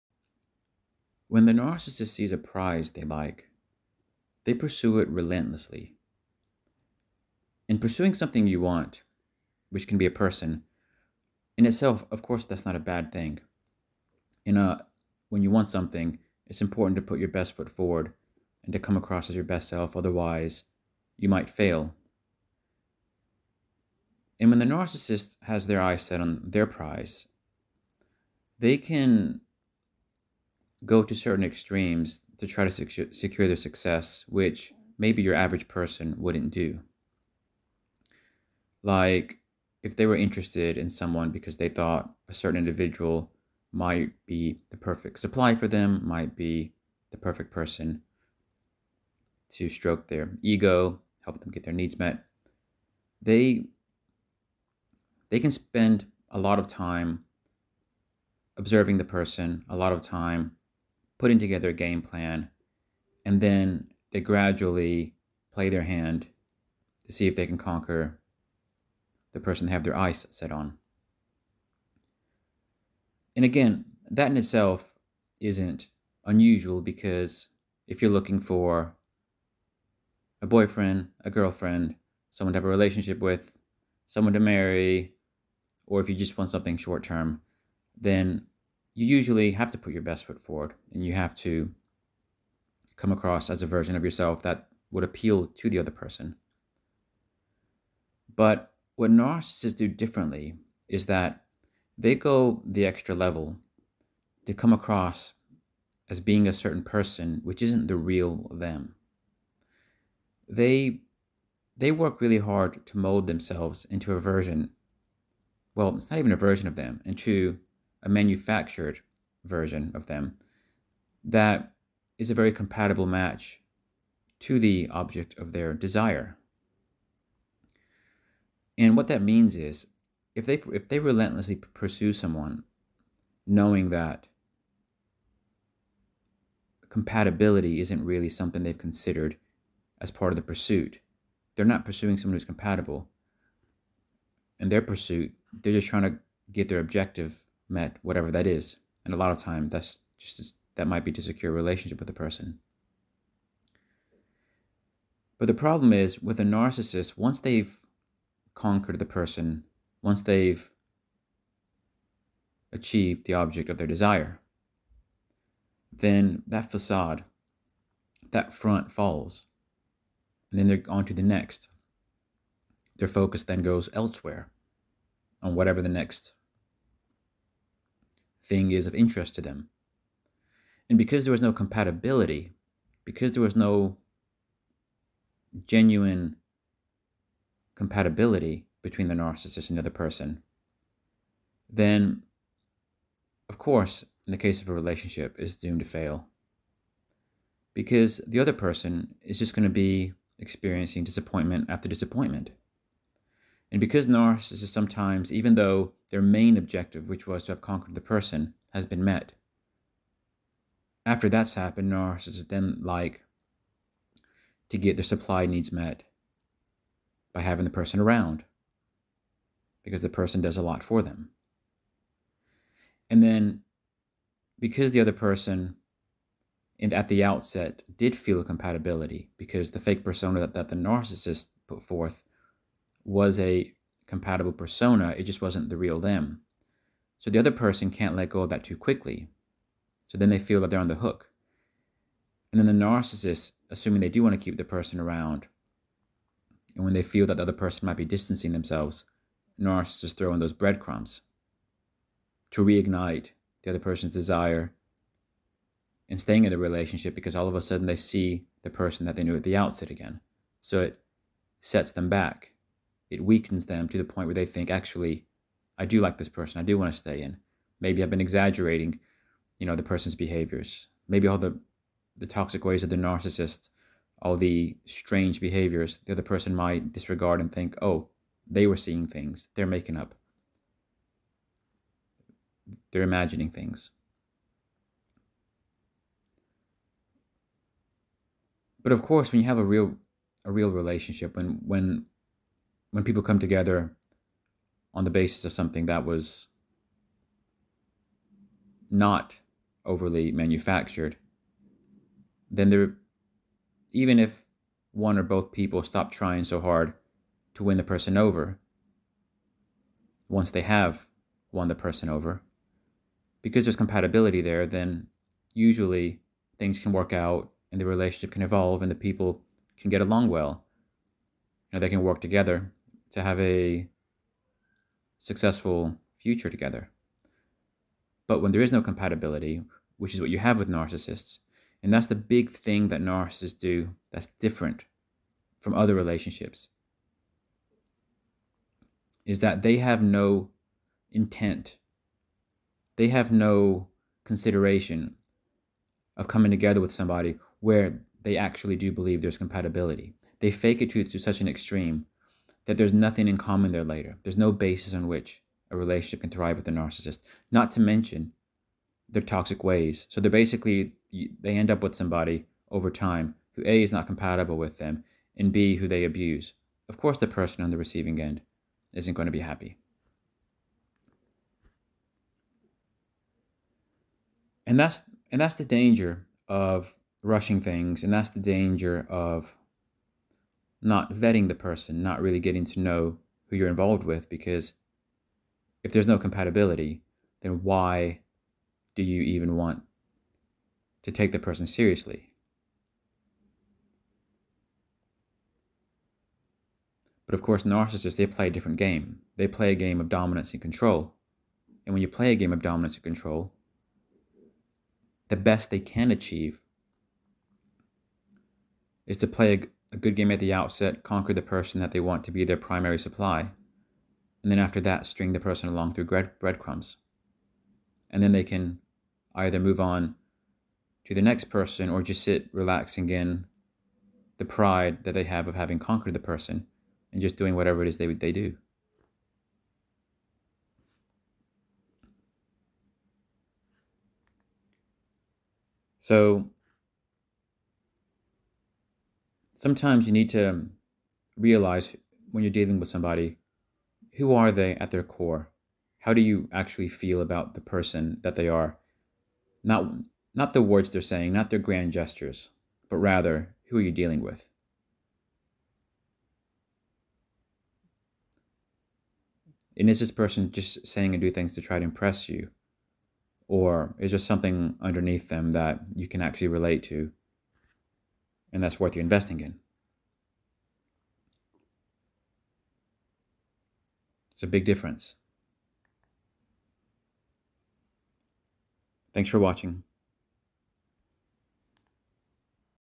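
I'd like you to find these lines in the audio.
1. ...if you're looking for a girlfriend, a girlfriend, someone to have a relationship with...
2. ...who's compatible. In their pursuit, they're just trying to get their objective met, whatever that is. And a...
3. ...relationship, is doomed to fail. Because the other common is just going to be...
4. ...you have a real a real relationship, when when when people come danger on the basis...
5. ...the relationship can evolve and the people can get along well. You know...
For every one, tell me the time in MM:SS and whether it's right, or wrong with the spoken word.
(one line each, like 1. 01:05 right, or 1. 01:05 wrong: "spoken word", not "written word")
1. 01:17 wrong: "boyfriend", not "girlfriend"
2. 02:22 right
3. 03:14 wrong: "person", not "common"
4. 04:49 wrong: "together", not "danger"
5. 05:17 right.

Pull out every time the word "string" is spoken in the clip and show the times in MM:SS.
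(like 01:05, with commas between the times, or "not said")
06:55.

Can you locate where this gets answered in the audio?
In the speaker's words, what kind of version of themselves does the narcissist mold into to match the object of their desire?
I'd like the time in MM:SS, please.
01:58.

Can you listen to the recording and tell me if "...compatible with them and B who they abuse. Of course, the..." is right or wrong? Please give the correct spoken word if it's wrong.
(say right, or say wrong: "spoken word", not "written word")
right.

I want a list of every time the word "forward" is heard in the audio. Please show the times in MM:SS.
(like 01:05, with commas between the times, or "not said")
00:17, 01:30.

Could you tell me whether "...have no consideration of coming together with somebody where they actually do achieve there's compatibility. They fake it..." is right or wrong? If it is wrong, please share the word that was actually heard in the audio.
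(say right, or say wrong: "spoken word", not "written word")
wrong: "believe", not "achieve".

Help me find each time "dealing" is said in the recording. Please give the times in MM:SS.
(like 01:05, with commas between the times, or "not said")
07:22, 07:33.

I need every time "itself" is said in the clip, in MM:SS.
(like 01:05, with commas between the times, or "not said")
00:11, 01:14.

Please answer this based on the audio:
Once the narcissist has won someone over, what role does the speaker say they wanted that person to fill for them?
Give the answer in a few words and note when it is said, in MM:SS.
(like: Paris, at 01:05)
primary supply, at 06:52.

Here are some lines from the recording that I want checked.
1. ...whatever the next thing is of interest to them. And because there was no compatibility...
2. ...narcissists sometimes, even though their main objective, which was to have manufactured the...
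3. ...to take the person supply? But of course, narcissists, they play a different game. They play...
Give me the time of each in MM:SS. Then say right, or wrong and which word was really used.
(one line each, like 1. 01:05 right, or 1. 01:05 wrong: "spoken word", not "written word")
1. 02:55 right
2. 03:24 wrong: "conquered", not "manufactured"
3. 06:31 wrong: "seriously", not "supply".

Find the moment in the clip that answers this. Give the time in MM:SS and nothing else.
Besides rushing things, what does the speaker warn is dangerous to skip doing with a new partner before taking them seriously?
06:21.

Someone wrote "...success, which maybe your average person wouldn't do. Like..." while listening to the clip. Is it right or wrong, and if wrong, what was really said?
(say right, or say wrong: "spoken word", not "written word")
right.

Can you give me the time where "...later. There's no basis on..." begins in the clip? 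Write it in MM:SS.
05:53.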